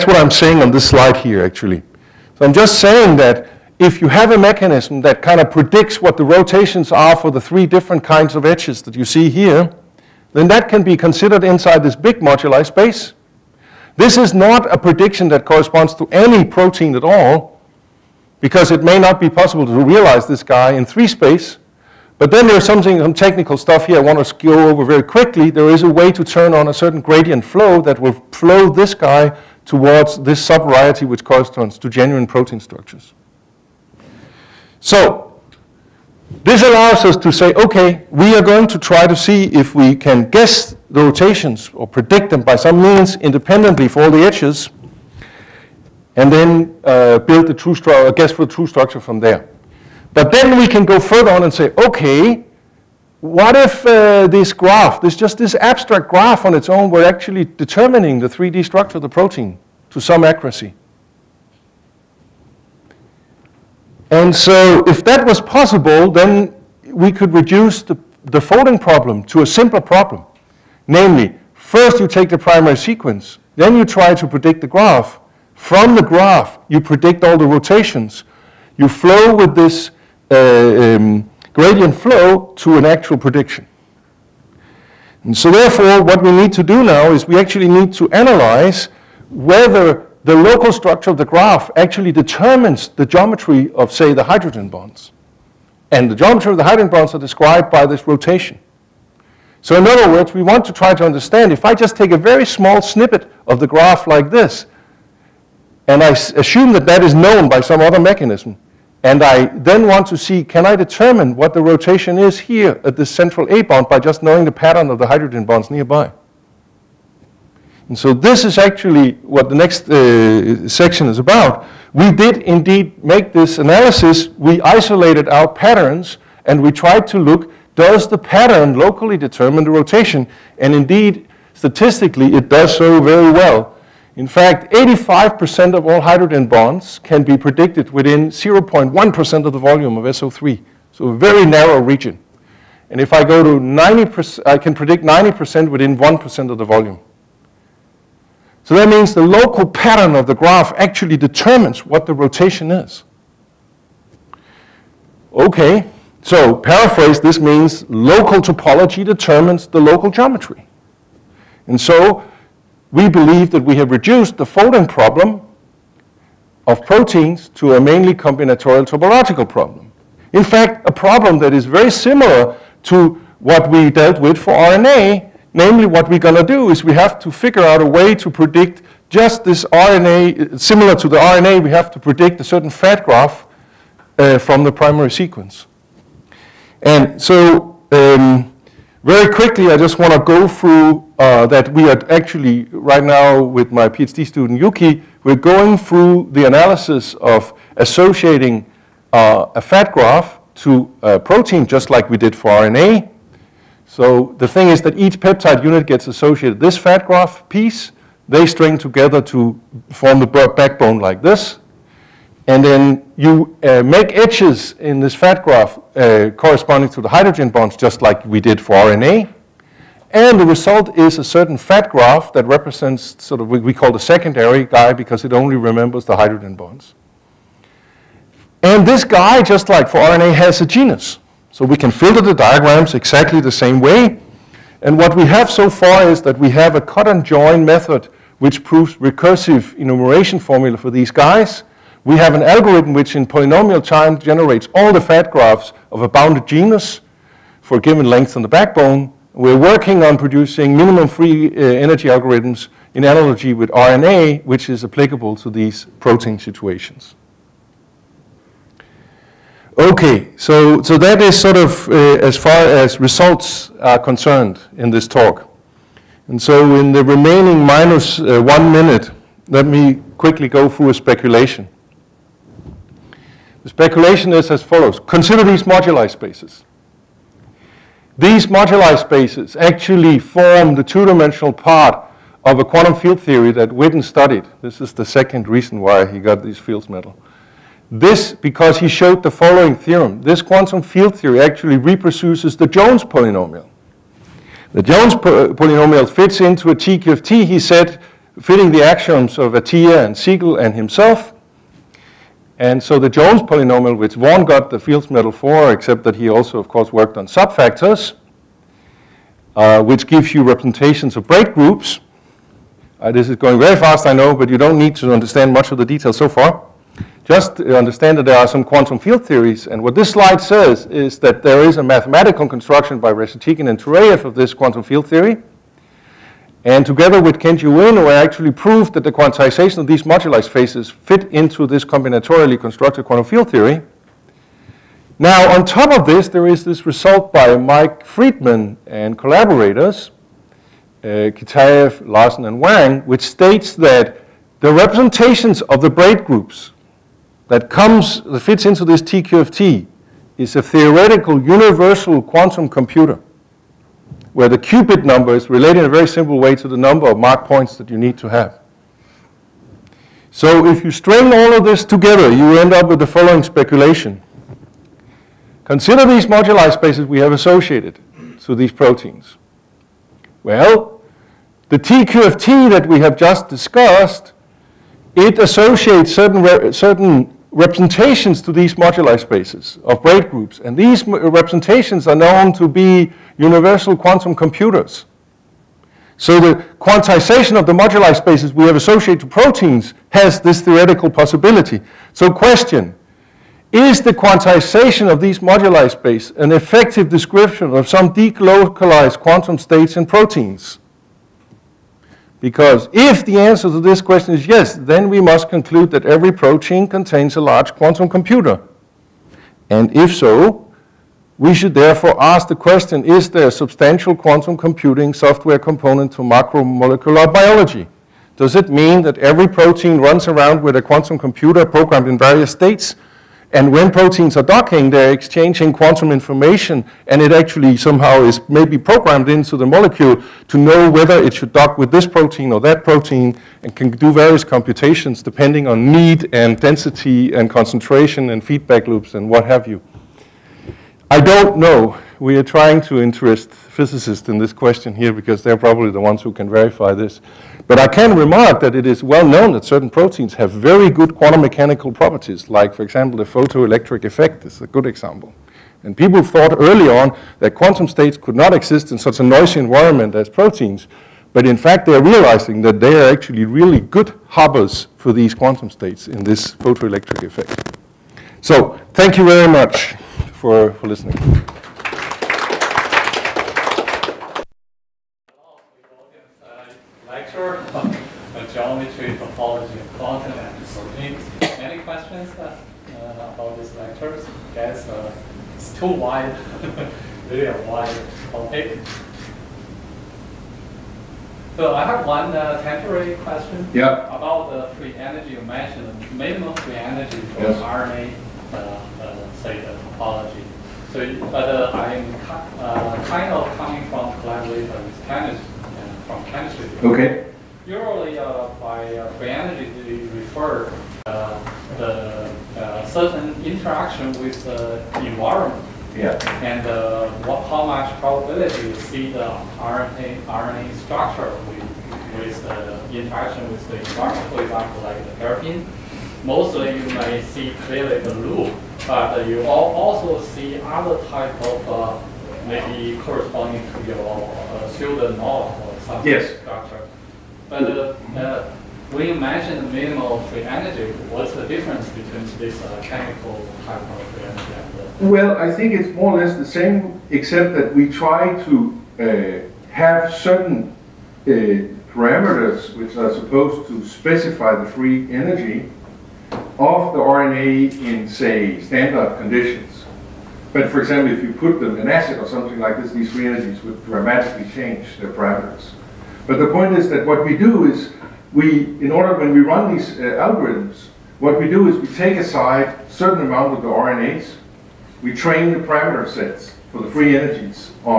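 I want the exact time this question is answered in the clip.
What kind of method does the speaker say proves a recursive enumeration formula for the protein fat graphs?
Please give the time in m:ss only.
3:56.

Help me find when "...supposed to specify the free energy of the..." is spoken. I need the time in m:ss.
9:13.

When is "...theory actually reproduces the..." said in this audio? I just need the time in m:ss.
4:51.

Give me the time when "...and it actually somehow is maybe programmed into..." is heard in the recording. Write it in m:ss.
7:07.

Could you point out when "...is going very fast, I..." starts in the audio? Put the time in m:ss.
5:13.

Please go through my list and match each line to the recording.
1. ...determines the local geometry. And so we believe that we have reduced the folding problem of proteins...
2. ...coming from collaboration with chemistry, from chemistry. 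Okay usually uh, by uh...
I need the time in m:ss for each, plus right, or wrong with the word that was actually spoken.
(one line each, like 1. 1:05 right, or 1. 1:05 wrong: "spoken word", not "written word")
1. 2:39 right
2. 8:23 right.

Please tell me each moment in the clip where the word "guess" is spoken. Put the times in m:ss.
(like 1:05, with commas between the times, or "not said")
0:40, 0:48.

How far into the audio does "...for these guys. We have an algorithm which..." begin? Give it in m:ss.
4:00.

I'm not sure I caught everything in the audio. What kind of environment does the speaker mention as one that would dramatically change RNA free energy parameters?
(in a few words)
acid.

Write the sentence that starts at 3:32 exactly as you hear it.
And then you uh, make edges in this fat graph uh, corresponding to the hydrogen bonds, just like we did for RNA.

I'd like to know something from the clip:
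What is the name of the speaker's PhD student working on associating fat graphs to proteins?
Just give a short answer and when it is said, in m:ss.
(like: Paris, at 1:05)
Yuki, at 3:14.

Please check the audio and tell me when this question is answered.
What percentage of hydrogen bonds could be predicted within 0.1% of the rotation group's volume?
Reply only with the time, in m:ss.
2:14.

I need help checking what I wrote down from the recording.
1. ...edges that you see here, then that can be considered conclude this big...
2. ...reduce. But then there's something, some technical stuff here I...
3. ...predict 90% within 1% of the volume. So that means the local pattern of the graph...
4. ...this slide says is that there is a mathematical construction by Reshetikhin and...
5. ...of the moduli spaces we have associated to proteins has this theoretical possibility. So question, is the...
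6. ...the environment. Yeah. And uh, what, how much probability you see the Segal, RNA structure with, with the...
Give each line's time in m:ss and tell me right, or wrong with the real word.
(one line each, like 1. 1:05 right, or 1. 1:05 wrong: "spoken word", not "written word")
1. 0:08 wrong: "inside", not "conclude"
2. 0:21 wrong: "space", not "reduce"
3. 2:24 right
4. 5:19 right
5. 6:27 right
6. 8:34 wrong: "RNA", not "Segal".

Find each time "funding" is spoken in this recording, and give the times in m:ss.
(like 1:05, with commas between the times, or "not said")
not said.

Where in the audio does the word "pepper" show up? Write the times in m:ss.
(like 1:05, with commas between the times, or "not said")
not said.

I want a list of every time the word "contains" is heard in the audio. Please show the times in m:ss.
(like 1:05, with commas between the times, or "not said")
6:46.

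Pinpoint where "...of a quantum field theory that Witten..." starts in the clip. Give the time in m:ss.
4:42.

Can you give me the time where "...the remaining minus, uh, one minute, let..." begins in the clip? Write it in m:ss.
4:26.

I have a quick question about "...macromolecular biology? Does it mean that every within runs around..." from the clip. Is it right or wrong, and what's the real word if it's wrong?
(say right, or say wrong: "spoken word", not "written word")
wrong: "protein", not "within".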